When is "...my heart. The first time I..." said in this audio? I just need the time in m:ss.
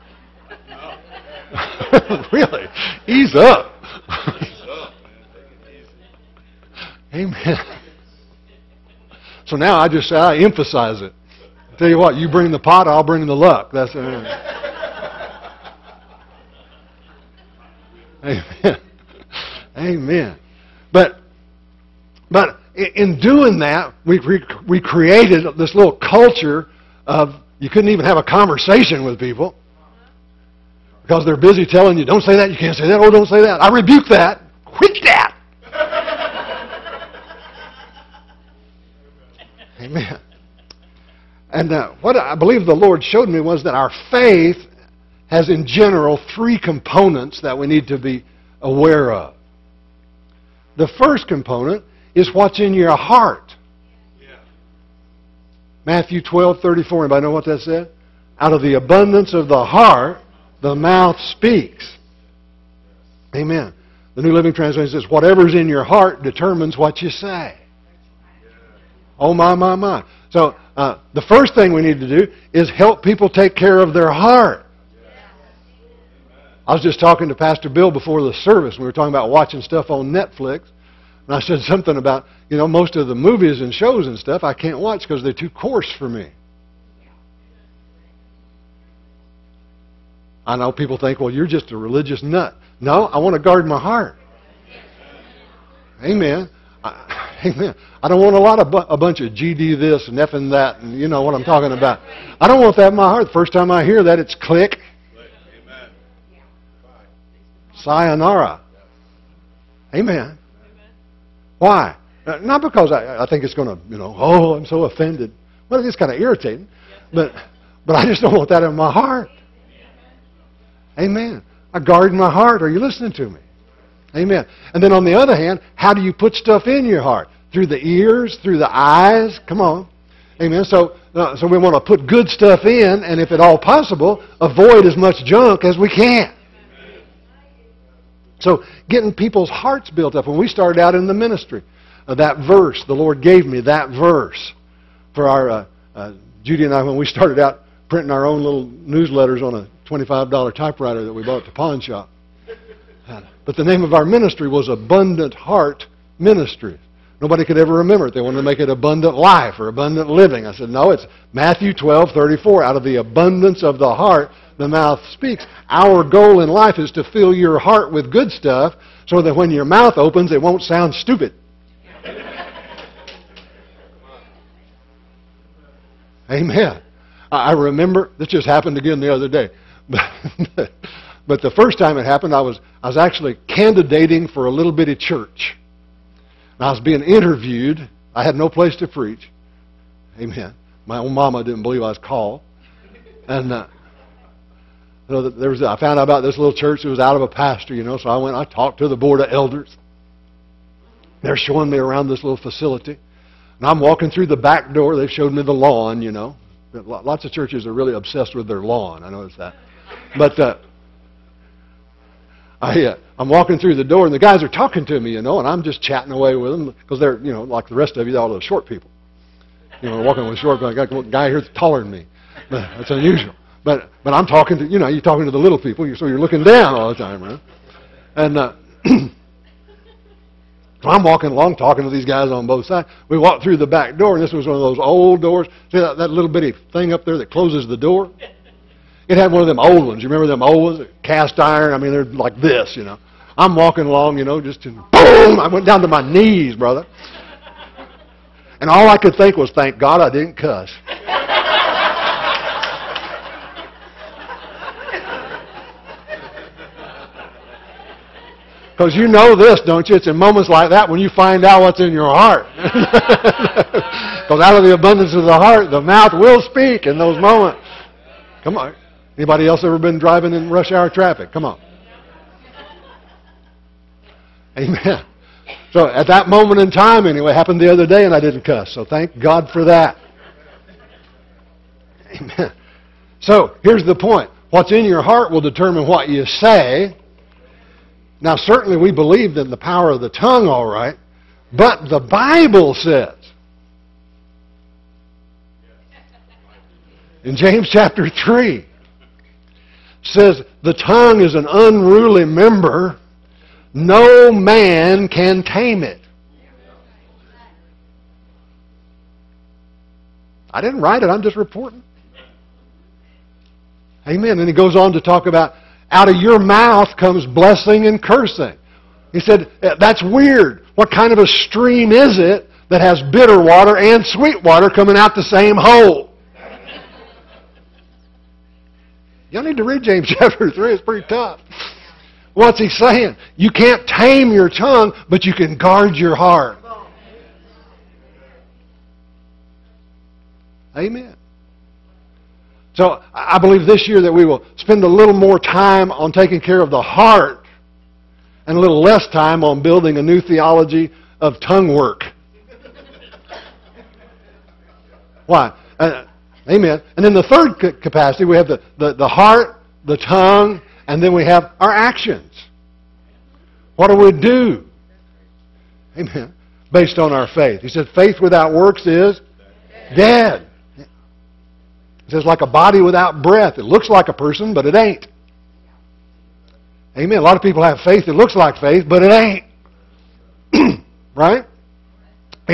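1:42.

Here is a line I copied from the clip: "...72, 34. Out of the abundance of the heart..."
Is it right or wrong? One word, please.
wrong.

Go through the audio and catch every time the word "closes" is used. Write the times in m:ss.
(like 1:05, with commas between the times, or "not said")
3:57.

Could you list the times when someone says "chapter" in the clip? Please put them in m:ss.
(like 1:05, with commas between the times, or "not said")
4:57, 5:30.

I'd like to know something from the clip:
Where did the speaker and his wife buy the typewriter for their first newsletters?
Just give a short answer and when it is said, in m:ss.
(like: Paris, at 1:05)
pawn shop, at 2:31.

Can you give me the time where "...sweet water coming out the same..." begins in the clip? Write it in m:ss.
5:24.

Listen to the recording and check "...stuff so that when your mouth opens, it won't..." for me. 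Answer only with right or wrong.
right.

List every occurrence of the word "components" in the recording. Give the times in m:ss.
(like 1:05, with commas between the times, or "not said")
0:46, 0:51.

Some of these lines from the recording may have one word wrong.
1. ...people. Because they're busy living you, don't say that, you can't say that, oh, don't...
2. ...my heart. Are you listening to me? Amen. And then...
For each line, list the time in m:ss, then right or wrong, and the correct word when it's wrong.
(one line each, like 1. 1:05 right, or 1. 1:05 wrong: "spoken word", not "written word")
1. 0:29 wrong: "telling", not "living"
2. 2:02 right.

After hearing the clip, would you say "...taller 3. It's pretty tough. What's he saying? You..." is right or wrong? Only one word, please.
wrong.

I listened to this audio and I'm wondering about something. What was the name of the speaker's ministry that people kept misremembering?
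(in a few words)
Abundant Heart Ministry.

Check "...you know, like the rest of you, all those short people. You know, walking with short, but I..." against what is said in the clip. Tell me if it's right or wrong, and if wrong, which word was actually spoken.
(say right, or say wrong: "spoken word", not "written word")
right.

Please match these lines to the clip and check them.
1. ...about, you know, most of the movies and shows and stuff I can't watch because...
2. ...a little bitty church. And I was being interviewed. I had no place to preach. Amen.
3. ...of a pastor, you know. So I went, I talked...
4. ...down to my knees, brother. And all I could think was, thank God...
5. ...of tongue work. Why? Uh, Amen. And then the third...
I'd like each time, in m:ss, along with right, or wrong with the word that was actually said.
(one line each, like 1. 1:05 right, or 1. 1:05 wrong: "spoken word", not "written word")
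1. 1:21 right
2. 3:04 right
3. 3:17 right
4. 4:05 right
5. 5:51 right.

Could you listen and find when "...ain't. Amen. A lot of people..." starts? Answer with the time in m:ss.
6:14.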